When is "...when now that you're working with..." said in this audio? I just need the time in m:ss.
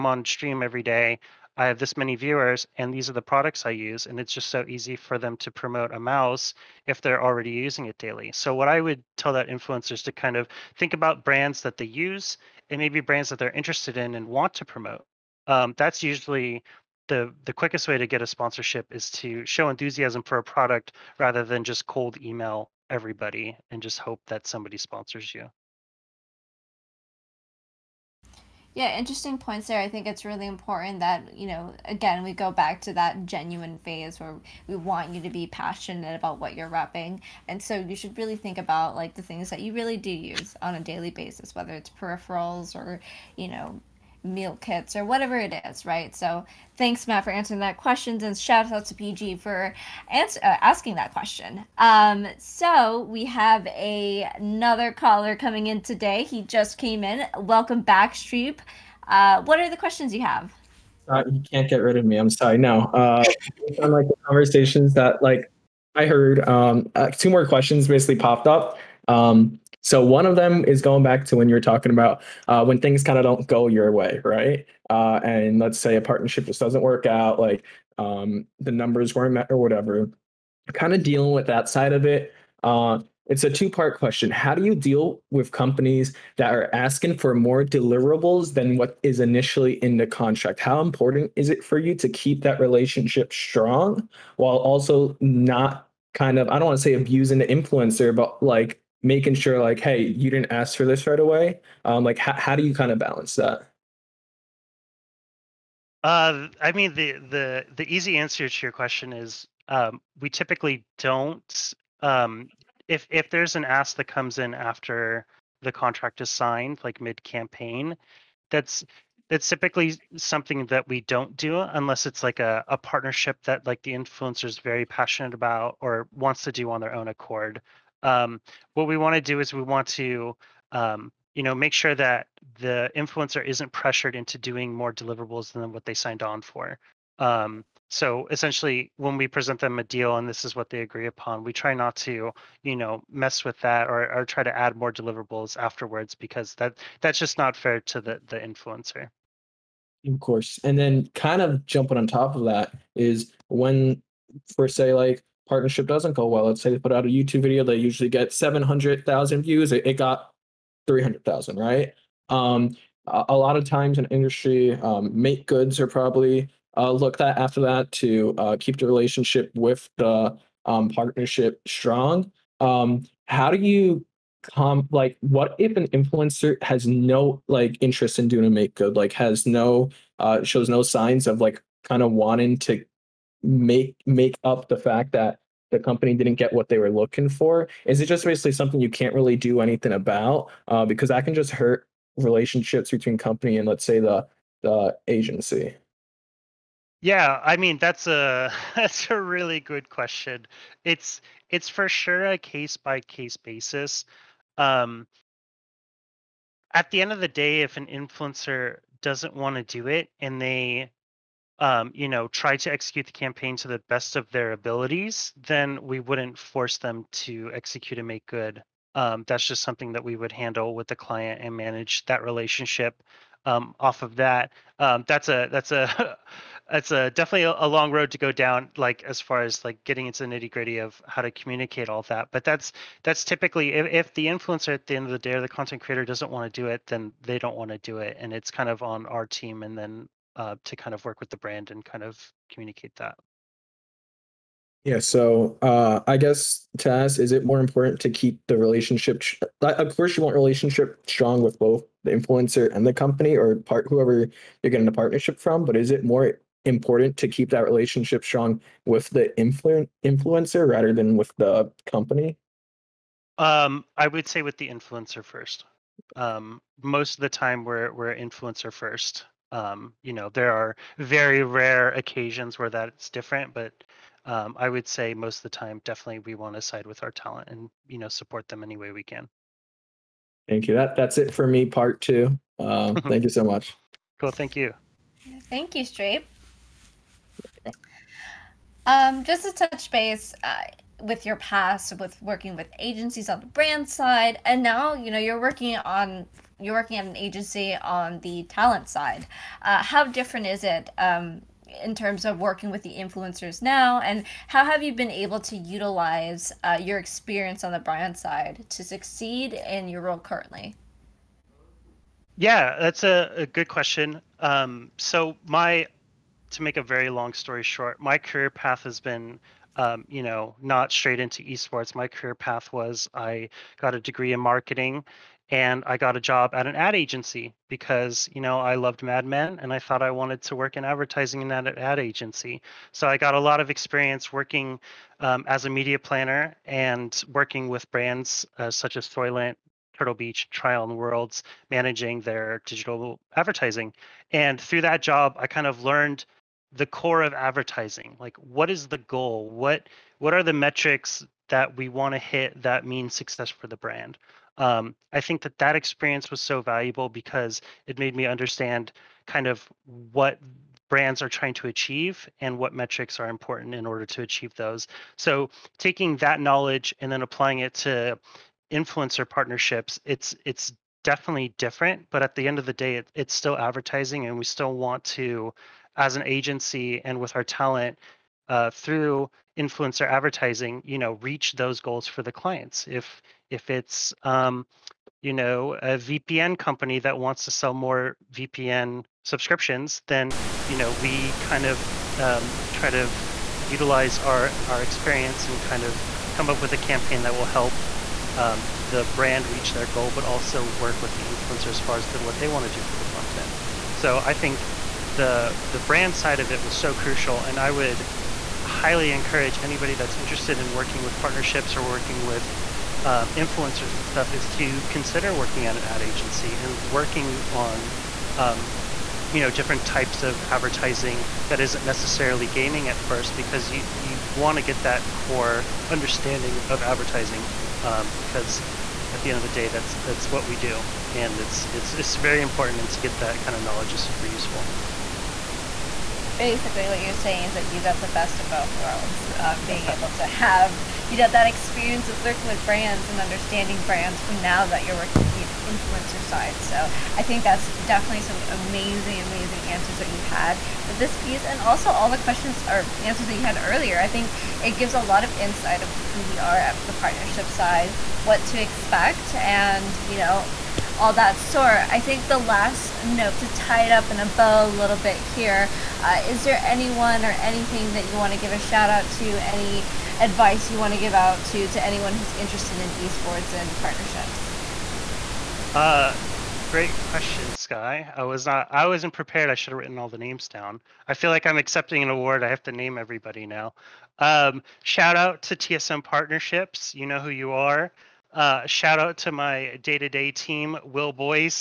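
7:24.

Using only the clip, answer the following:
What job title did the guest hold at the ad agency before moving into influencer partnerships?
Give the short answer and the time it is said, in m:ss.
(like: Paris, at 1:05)
media planner, at 5:35.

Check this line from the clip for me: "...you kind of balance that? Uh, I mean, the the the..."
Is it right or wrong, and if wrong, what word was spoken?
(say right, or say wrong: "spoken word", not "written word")
right.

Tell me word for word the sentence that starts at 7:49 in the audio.
Any advice you want to give out to to anyone who's interested in esports and partnerships?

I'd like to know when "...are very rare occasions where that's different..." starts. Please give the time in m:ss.
4:30.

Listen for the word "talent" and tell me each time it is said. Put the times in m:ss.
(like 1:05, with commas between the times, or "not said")
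4:37, 4:58, 6:17.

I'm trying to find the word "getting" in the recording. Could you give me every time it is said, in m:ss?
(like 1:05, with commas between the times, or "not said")
3:49, 4:14.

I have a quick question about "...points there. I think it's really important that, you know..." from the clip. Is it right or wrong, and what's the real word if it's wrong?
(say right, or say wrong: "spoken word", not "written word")
right.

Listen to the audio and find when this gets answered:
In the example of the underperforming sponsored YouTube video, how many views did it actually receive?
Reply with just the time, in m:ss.
2:40.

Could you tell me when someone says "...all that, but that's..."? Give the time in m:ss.
3:51.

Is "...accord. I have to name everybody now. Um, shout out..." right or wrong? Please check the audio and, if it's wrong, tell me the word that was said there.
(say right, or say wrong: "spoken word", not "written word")
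wrong: "award", not "accord".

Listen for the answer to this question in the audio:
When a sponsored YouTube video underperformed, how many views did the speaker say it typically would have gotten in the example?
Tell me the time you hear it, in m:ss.
2:38.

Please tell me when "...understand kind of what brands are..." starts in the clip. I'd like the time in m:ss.
5:58.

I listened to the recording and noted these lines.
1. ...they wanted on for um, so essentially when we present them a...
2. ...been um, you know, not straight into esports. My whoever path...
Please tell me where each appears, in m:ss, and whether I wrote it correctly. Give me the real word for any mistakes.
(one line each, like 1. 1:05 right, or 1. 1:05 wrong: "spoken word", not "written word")
1. 2:15 wrong: "signed", not "wanted"
2. 5:18 wrong: "career", not "whoever".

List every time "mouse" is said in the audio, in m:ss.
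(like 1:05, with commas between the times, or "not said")
0:05.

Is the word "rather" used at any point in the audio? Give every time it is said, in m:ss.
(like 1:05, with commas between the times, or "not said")
0:21, 4:20.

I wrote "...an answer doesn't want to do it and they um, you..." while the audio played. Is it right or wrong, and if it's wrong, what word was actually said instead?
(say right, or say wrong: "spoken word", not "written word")
wrong: "influencer", not "answer".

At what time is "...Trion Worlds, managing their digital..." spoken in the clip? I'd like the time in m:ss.
5:40.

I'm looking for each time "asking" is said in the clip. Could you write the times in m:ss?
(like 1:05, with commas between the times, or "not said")
0:50, 1:26.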